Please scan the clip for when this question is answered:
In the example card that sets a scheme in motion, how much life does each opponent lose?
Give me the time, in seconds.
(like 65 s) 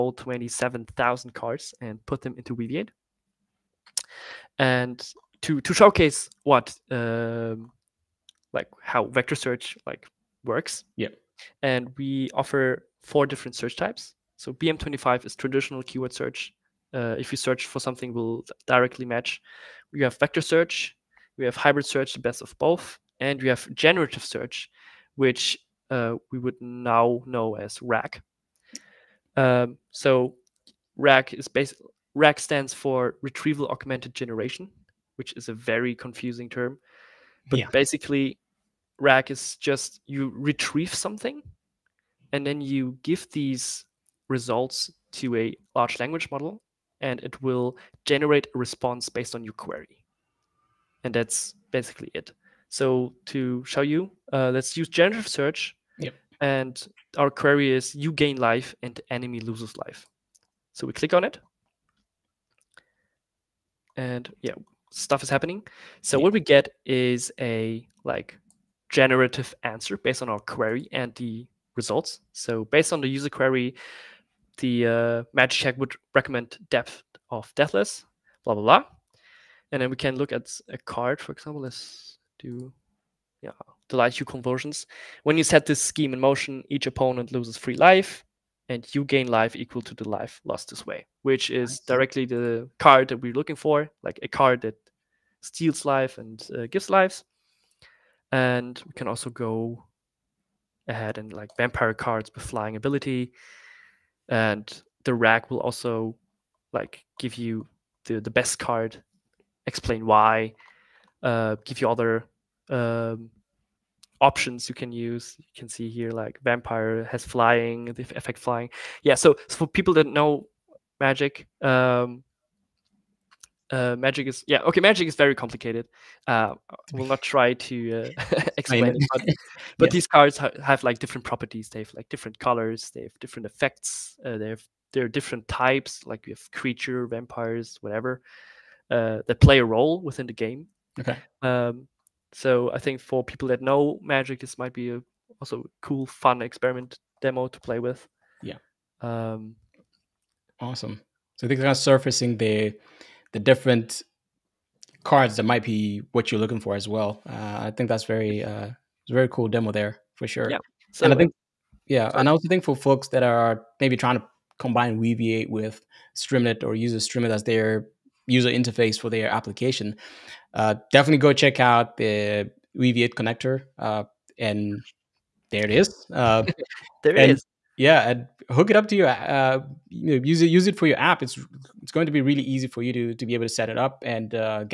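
87 s.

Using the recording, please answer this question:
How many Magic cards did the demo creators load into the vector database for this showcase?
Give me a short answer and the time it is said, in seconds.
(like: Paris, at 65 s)
27,000, at 0 s.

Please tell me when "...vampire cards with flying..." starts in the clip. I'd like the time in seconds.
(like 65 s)
101 s.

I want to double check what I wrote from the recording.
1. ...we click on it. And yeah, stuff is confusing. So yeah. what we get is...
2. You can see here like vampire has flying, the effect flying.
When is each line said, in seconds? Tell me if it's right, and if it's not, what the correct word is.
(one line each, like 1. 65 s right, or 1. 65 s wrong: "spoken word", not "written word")
1. 60 s wrong: "happening", not "confusing"
2. 115 s right.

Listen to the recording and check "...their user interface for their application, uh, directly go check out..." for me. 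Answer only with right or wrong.
wrong.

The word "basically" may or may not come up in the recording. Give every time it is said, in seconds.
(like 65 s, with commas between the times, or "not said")
31 s, 37 s, 51 s.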